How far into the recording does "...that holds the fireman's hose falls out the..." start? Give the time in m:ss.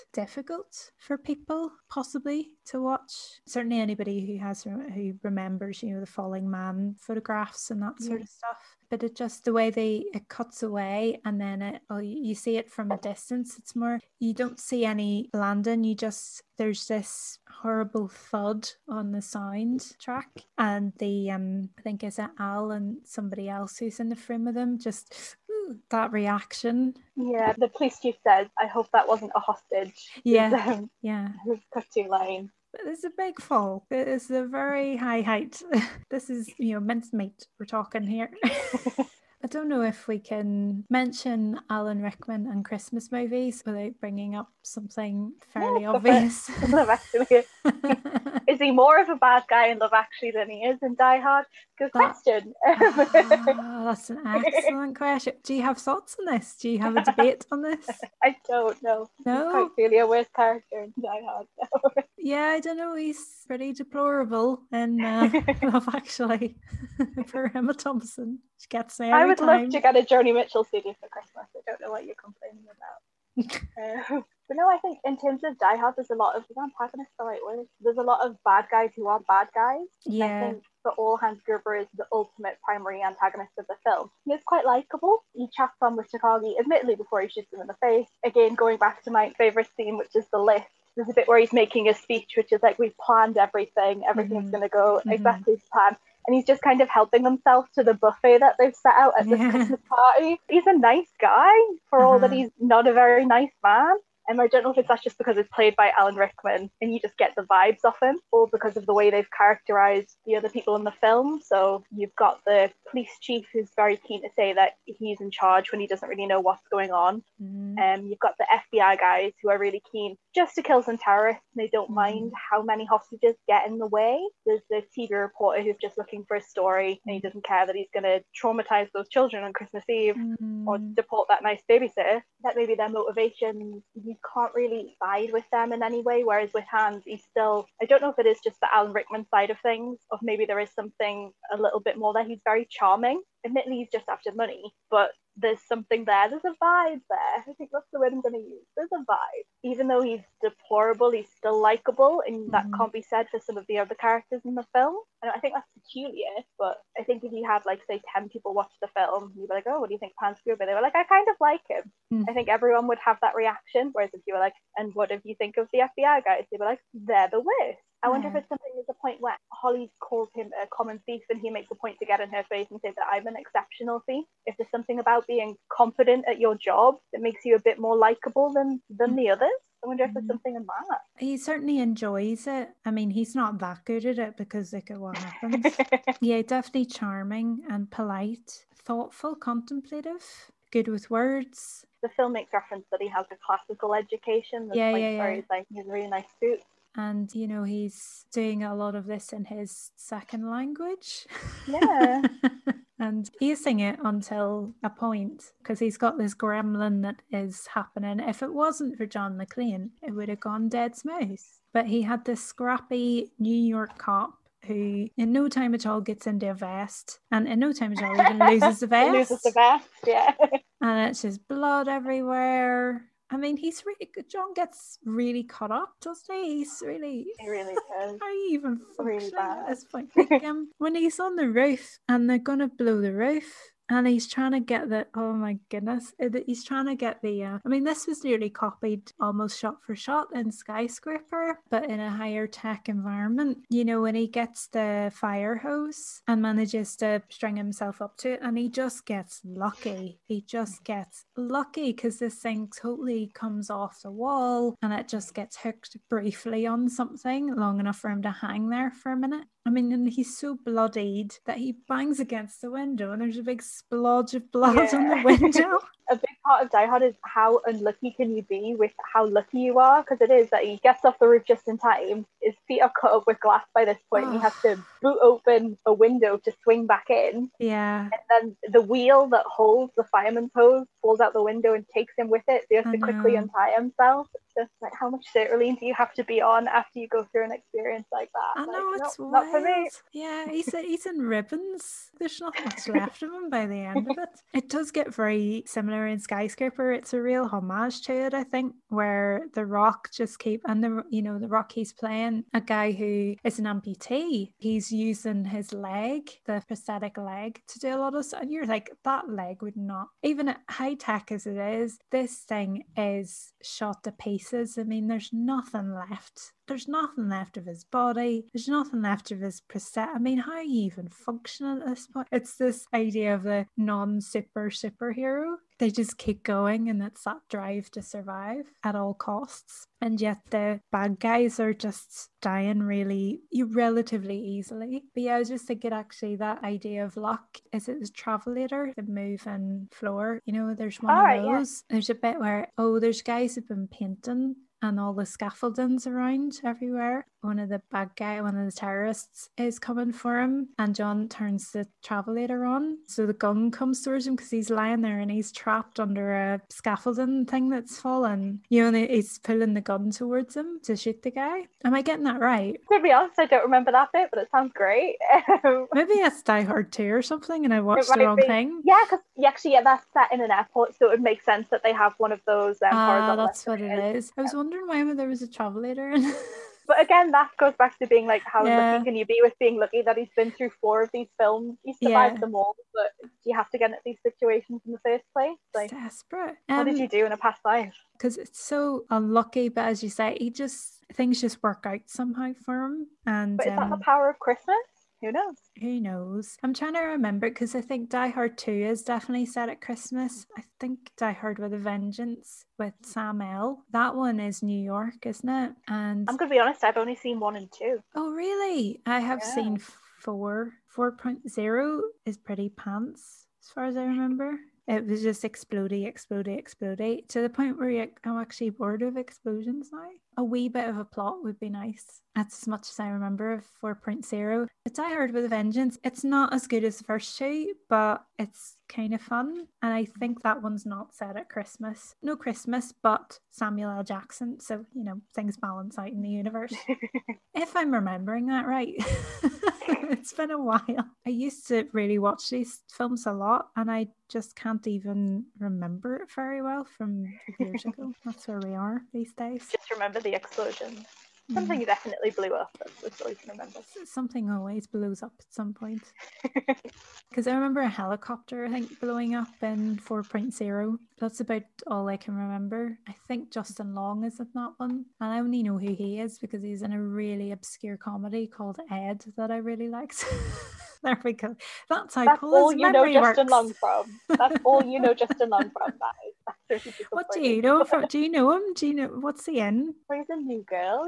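4:39.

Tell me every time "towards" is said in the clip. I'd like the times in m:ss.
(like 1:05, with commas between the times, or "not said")
5:54, 6:00.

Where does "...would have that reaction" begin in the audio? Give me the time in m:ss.
2:42.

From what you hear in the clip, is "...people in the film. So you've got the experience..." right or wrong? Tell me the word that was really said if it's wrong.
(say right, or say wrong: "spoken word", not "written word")
wrong: "police", not "experience".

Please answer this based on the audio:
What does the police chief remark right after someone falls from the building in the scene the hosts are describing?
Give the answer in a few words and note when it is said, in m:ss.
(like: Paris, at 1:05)
I hope that wasn't a hostage, at 0:28.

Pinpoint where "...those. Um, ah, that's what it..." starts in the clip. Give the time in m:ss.
6:12.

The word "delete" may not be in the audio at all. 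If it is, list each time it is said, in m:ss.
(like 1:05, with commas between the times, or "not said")
not said.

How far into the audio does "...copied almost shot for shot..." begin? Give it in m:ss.
3:58.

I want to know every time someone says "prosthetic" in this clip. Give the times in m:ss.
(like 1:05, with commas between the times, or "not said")
5:06, 5:19.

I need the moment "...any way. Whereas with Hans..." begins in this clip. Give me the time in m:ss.
2:15.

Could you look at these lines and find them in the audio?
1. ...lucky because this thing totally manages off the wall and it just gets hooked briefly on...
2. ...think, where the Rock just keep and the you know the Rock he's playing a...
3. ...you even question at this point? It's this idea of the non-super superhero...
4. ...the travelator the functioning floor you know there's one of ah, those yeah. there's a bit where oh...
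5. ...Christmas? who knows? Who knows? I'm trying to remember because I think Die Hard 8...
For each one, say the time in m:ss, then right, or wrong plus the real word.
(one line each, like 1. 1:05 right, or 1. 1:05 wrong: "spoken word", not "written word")
1. 4:11 wrong: "comes", not "manages"
2. 4:58 right
3. 5:20 wrong: "function", not "question"
4. 5:37 wrong: "moving", not "functioning"
5. 6:34 wrong: "2", not "8".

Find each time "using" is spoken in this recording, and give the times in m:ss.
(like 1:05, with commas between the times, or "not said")
3:23, 5:04.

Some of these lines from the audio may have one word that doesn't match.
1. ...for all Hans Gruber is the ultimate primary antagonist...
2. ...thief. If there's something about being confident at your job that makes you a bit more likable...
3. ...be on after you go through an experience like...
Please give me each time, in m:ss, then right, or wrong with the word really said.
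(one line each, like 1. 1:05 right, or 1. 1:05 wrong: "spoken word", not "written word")
1. 1:20 right
2. 2:54 right
3. 4:46 right.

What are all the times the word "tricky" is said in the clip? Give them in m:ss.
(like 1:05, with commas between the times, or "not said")
not said.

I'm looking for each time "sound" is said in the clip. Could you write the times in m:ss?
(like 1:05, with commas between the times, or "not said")
0:19, 6:04.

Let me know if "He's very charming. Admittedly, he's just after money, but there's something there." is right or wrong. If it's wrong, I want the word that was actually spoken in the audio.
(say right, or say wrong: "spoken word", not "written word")
right.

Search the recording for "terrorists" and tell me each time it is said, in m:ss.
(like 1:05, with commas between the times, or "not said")
2:00, 5:48.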